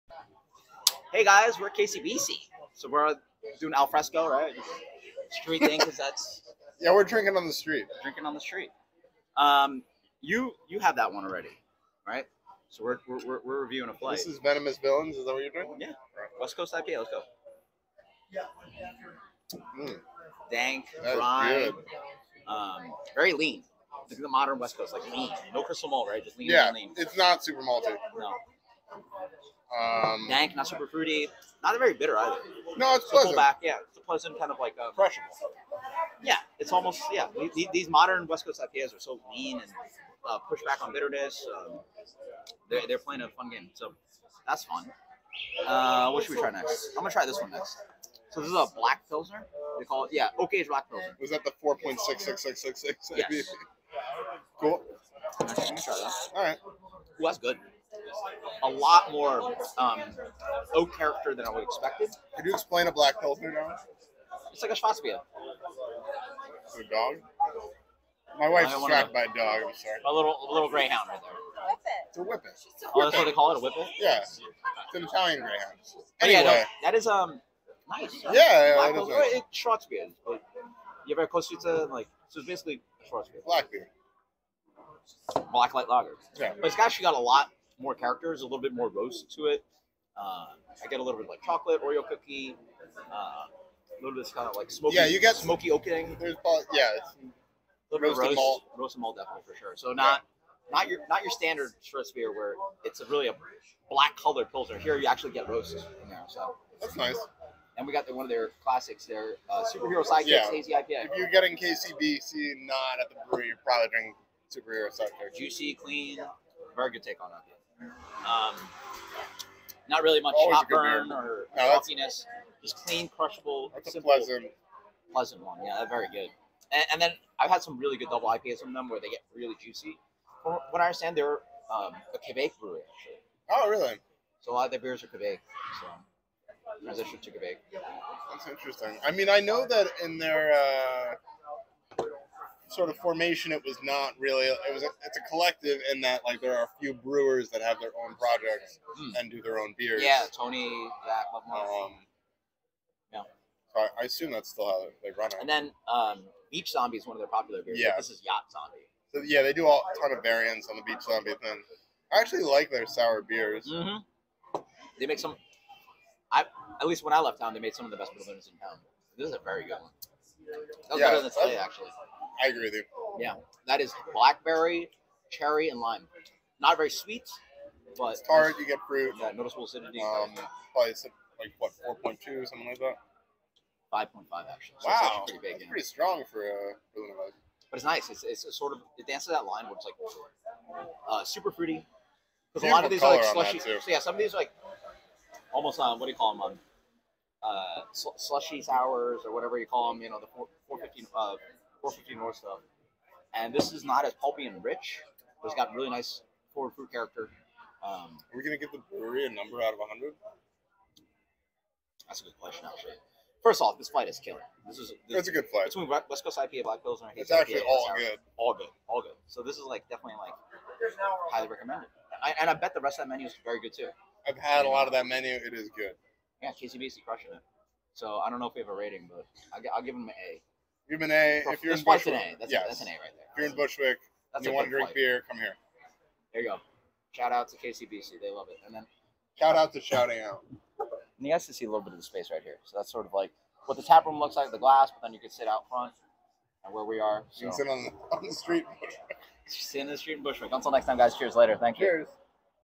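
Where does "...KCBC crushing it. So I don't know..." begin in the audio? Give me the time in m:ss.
3:46.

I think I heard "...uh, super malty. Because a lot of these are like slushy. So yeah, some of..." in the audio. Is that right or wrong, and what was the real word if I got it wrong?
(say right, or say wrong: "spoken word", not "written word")
wrong: "fruity", not "malty".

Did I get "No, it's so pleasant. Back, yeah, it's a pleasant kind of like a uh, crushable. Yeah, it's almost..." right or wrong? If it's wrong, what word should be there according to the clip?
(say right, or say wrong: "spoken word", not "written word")
right.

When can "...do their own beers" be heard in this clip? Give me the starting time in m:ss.
2:29.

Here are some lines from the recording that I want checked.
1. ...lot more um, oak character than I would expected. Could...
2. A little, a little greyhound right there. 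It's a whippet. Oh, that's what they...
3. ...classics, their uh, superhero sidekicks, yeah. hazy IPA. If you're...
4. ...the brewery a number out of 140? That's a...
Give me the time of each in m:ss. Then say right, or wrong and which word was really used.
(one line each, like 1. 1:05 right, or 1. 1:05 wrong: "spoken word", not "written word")
1. 0:58 right
2. 1:10 right
3. 1:48 right
4. 3:28 wrong: "100", not "140".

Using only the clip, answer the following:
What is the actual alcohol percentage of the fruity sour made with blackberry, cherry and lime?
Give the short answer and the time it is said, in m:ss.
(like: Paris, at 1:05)
5.5, at 3:03.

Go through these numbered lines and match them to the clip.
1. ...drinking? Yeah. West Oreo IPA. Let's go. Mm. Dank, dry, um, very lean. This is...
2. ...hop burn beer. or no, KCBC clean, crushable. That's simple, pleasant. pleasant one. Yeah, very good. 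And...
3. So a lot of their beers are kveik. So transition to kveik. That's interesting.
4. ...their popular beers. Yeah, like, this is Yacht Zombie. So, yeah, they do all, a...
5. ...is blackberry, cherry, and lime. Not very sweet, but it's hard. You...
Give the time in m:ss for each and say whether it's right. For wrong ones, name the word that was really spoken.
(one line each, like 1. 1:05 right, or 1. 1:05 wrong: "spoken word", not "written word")
1. 0:15 wrong: "Coast", not "Oreo"
2. 2:00 wrong: "Just", not "KCBC"
3. 2:14 right
4. 2:37 right
5. 2:53 right.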